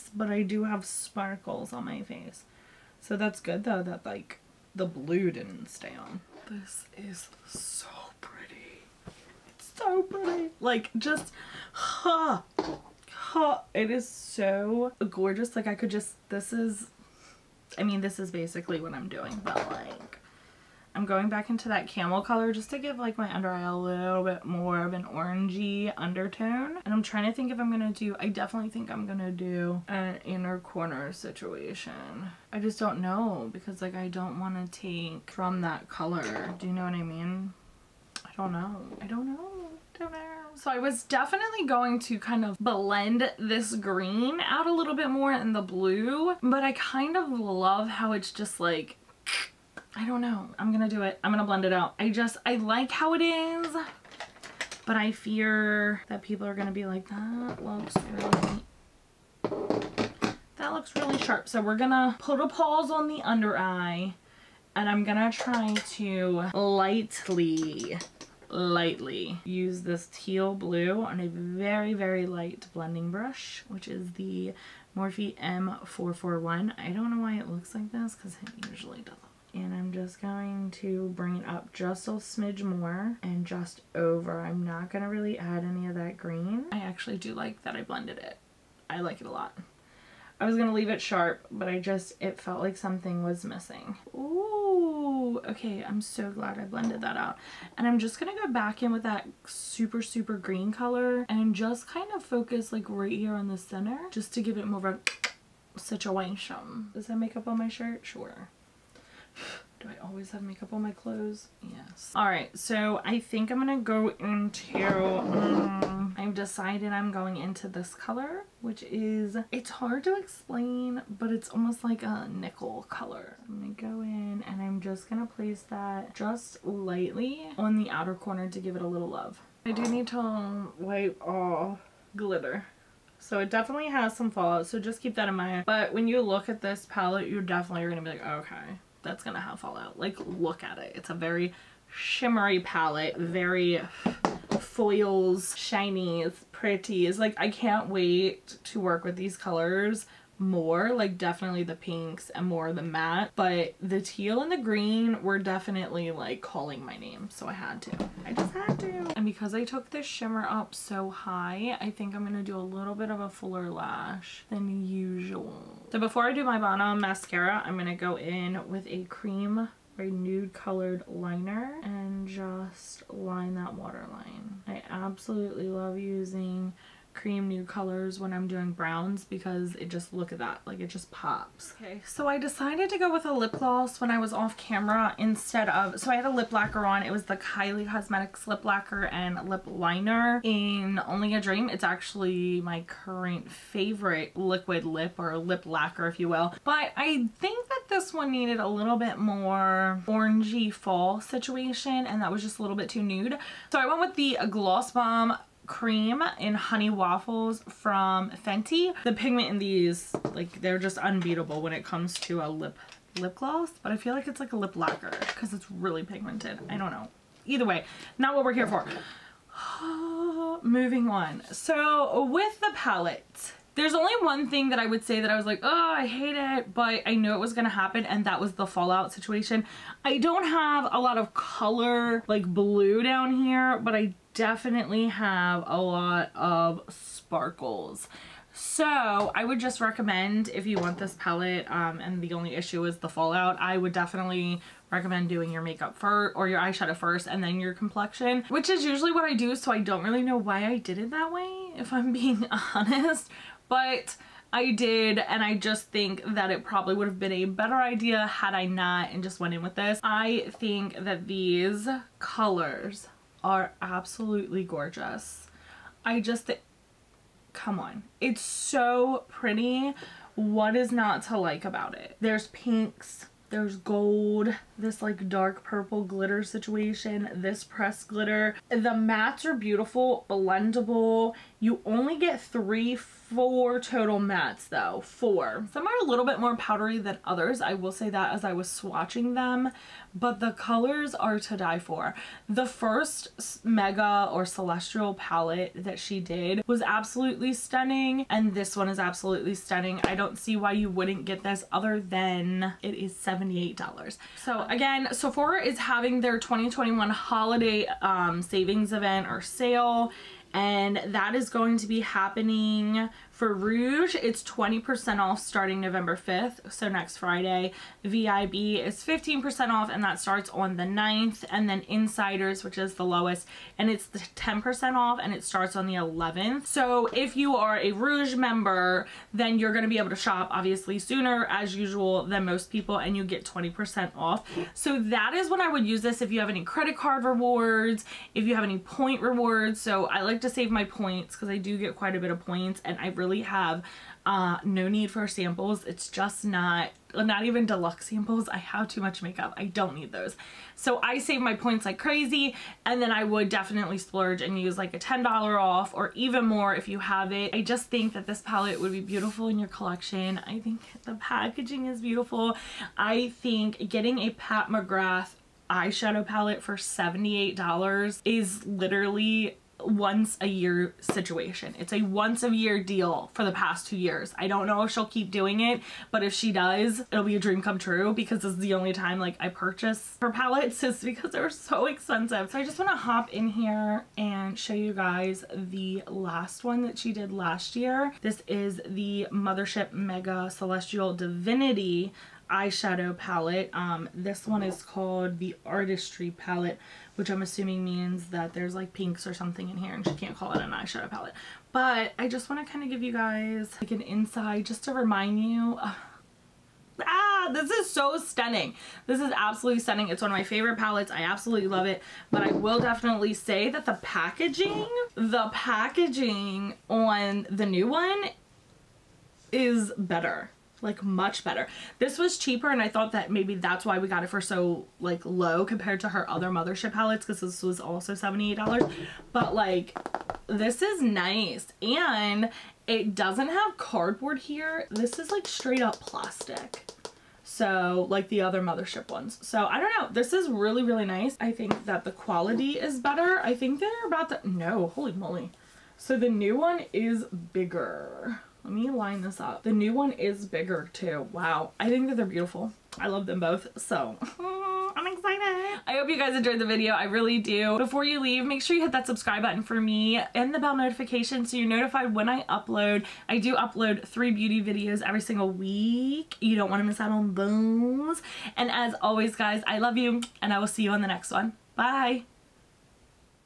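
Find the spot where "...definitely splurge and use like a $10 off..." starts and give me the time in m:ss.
5:53.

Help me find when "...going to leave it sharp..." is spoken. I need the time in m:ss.
1:30.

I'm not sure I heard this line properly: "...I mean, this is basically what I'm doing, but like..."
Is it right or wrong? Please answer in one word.
right.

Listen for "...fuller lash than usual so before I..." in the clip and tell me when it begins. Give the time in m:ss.
2:43.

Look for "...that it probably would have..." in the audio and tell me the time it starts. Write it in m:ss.
4:16.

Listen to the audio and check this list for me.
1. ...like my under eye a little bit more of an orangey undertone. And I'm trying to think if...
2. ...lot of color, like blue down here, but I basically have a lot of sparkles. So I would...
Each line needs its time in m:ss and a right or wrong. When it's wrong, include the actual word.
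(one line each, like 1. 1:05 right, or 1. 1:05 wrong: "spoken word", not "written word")
1. 0:22 right
2. 3:50 wrong: "definitely", not "basically".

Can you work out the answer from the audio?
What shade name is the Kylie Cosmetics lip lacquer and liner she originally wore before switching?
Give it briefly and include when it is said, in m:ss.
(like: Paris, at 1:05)
Only a Dream, at 3:11.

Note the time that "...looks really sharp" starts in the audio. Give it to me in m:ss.
1:00.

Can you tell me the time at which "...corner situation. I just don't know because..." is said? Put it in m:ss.
0:30.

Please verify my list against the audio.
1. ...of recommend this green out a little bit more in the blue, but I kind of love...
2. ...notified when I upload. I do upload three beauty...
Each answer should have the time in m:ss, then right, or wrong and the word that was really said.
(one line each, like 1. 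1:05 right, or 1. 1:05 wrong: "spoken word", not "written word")
1. 0:42 wrong: "blend", not "recommend"
2. 7:41 right.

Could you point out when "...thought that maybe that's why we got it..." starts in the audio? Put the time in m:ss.
7:02.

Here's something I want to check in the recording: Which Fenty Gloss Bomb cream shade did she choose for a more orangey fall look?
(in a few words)
Honey Waffles.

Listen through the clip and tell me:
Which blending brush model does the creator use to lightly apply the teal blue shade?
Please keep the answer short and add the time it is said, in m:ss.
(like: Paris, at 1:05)
Morphe M441, at 1:14.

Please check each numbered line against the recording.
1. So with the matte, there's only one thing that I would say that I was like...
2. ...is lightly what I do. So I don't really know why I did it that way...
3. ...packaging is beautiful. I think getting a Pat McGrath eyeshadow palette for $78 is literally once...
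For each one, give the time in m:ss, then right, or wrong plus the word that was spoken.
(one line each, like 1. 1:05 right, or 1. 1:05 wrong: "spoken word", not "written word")
1. 3:41 wrong: "palette", not "matte"
2. 4:08 wrong: "usually", not "lightly"
3. 6:01 right.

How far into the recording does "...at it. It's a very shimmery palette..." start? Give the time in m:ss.
2:20.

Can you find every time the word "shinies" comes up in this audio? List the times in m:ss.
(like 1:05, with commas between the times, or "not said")
2:25.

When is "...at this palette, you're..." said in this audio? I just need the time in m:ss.
2:16.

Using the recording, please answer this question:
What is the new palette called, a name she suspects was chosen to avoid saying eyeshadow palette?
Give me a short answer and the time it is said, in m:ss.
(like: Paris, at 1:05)
Artistry palette, at 6:35.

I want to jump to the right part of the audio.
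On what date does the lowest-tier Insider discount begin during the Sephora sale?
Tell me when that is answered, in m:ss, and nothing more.
5:25.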